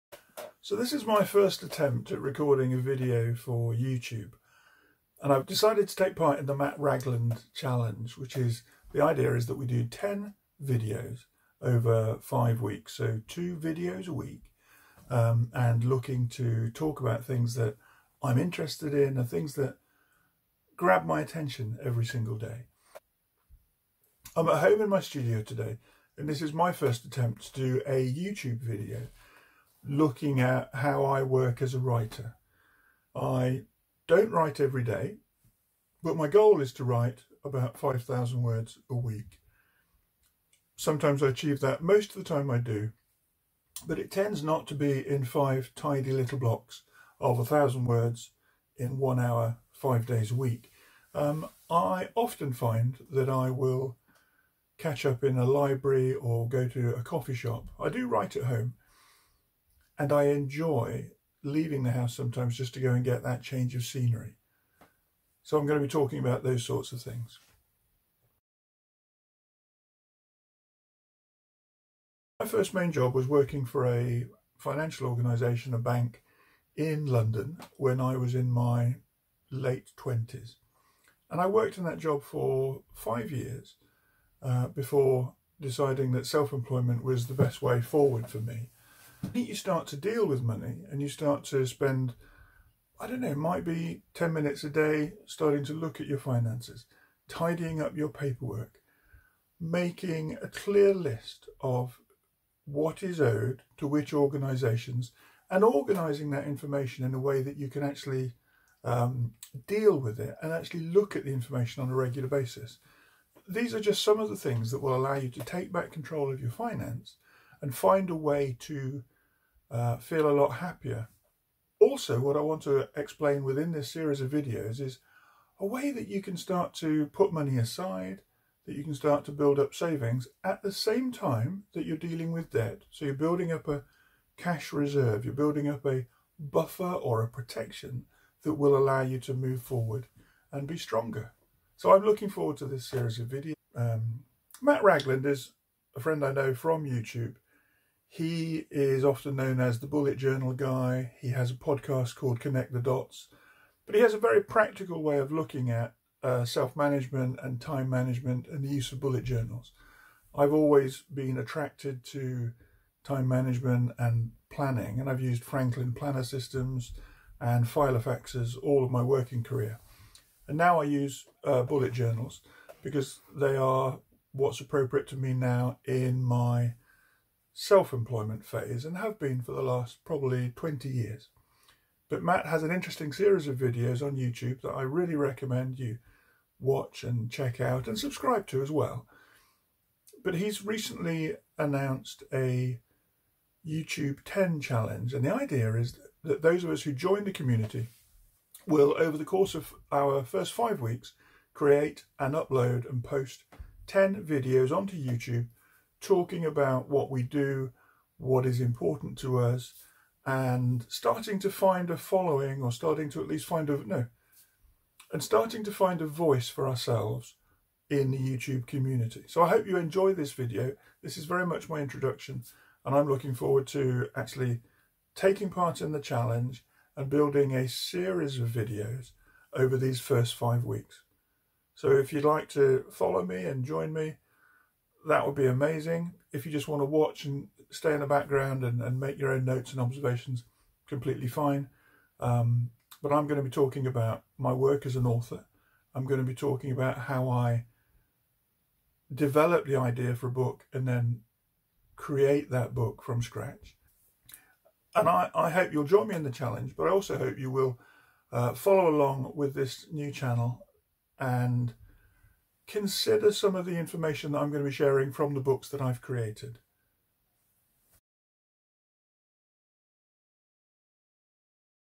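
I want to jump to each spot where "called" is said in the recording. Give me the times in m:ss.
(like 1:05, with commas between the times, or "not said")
2:32.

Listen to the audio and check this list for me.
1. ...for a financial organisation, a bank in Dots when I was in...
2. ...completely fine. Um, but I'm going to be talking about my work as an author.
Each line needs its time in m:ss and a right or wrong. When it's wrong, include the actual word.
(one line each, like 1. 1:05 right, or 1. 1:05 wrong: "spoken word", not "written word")
1. 1:13 wrong: "London", not "Dots"
2. 4:00 right.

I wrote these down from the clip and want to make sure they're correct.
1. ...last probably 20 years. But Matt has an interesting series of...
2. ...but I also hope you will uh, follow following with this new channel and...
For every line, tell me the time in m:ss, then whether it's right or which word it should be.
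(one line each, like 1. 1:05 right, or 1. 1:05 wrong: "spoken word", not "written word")
1. 2:59 right
2. 4:16 wrong: "along", not "following".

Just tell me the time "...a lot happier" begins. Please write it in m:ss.
2:00.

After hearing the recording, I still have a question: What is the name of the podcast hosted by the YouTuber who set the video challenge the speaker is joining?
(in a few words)
Connect the Dots.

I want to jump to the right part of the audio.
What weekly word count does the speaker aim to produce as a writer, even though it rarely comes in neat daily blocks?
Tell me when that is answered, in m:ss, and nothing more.
0:37.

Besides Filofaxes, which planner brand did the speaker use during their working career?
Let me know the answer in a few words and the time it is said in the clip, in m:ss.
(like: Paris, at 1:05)
Franklin Planner, at 2:45.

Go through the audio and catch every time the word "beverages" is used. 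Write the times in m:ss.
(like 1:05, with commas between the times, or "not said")
not said.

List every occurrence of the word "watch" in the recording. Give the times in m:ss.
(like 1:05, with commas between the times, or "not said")
3:06, 3:56.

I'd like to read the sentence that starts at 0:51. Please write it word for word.
Um, I often find that I will catch up in a library or go to a coffee shop.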